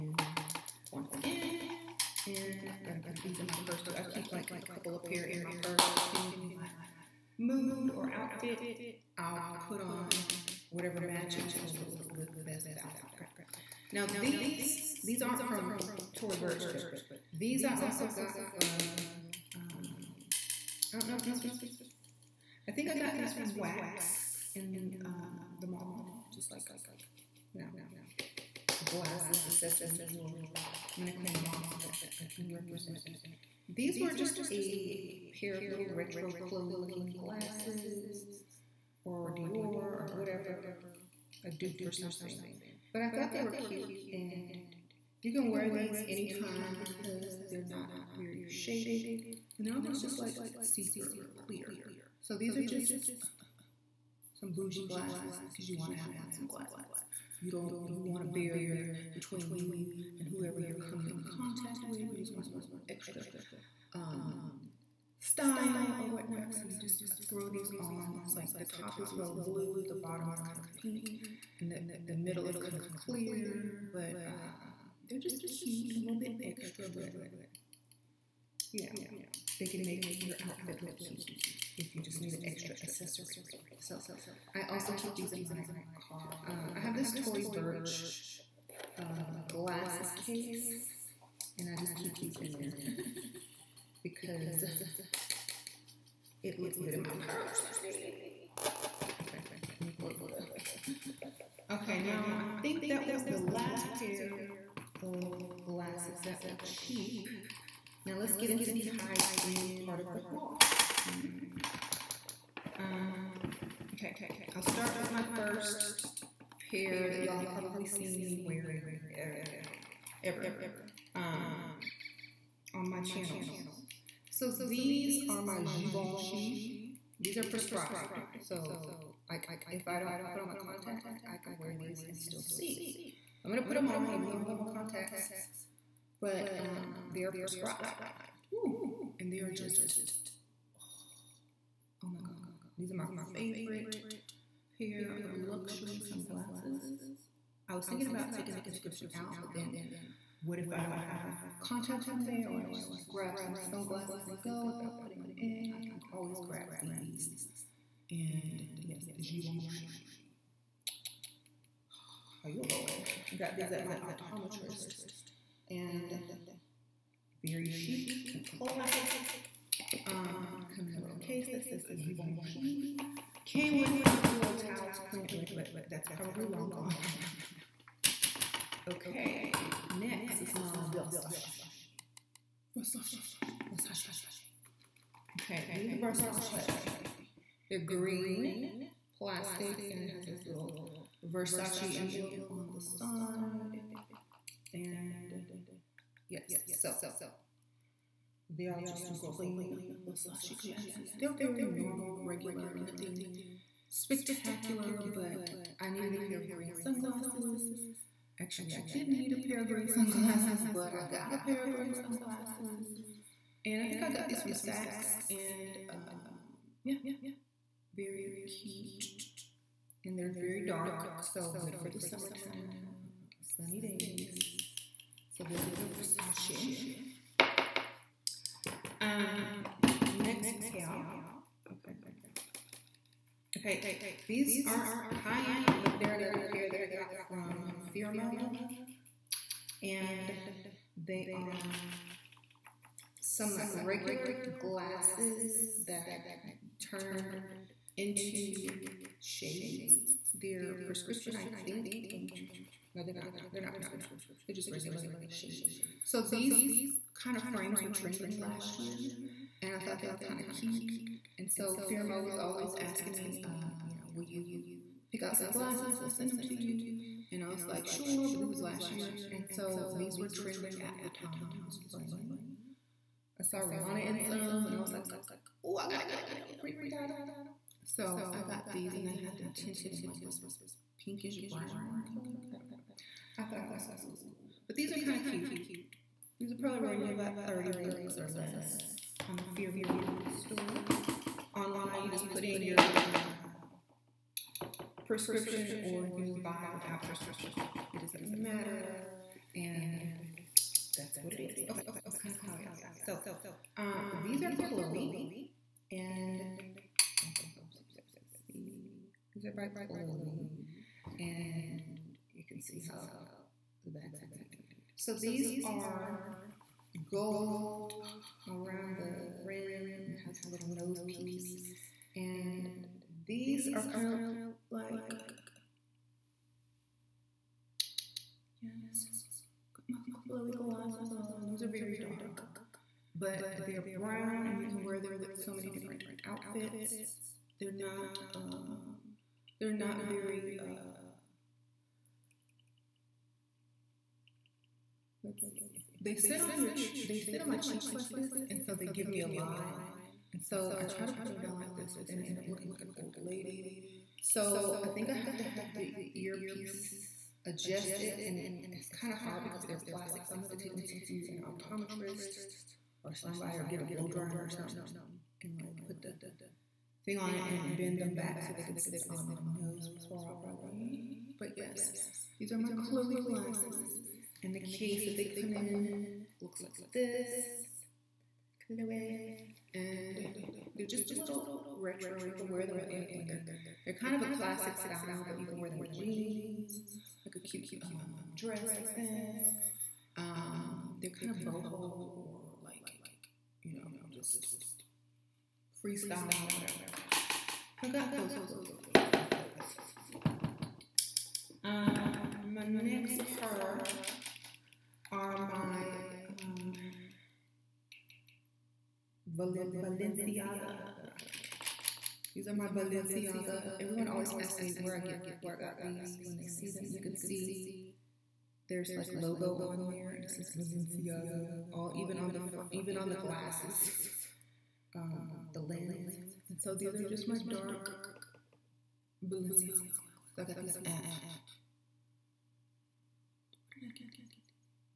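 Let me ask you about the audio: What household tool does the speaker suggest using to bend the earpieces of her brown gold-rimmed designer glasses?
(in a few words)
Blow dryer.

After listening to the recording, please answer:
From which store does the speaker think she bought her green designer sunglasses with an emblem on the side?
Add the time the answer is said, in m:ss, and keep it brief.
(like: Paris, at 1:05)
Saks, at 3:34.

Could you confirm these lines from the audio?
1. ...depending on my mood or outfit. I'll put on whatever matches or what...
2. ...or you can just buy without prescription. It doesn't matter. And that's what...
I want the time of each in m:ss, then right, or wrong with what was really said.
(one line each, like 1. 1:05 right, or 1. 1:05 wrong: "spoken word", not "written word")
1. 0:06 right
2. 4:55 right.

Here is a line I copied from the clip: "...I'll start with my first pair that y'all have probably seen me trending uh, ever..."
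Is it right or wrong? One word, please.
wrong.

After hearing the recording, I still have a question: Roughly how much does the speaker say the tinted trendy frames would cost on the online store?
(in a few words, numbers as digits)
$30 or less.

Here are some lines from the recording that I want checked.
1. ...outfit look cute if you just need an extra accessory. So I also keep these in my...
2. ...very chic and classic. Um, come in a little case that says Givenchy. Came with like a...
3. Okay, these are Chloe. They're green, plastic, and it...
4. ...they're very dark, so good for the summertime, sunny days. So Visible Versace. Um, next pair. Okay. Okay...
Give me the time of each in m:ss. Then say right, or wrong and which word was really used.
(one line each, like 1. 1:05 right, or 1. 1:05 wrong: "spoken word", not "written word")
1. 1:20 right
2. 2:47 right
3. 3:05 wrong: "Versace", not "Chloe"
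4. 3:40 right.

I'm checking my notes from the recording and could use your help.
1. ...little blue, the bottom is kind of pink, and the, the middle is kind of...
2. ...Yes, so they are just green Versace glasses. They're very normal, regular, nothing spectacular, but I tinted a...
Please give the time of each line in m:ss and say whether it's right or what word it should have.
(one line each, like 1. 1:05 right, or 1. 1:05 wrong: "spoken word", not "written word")
1. 1:09 right
2. 3:16 wrong: "needed", not "tinted".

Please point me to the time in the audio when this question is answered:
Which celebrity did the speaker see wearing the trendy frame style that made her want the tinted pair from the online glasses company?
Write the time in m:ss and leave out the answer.
4:33.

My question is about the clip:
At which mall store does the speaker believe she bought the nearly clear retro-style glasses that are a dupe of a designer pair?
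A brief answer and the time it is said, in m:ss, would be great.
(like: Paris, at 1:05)
Wax, at 0:23.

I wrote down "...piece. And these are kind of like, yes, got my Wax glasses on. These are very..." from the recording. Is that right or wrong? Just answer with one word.
wrong.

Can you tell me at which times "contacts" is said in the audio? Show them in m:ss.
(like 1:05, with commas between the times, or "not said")
1:01, 2:10, 2:14, 2:31.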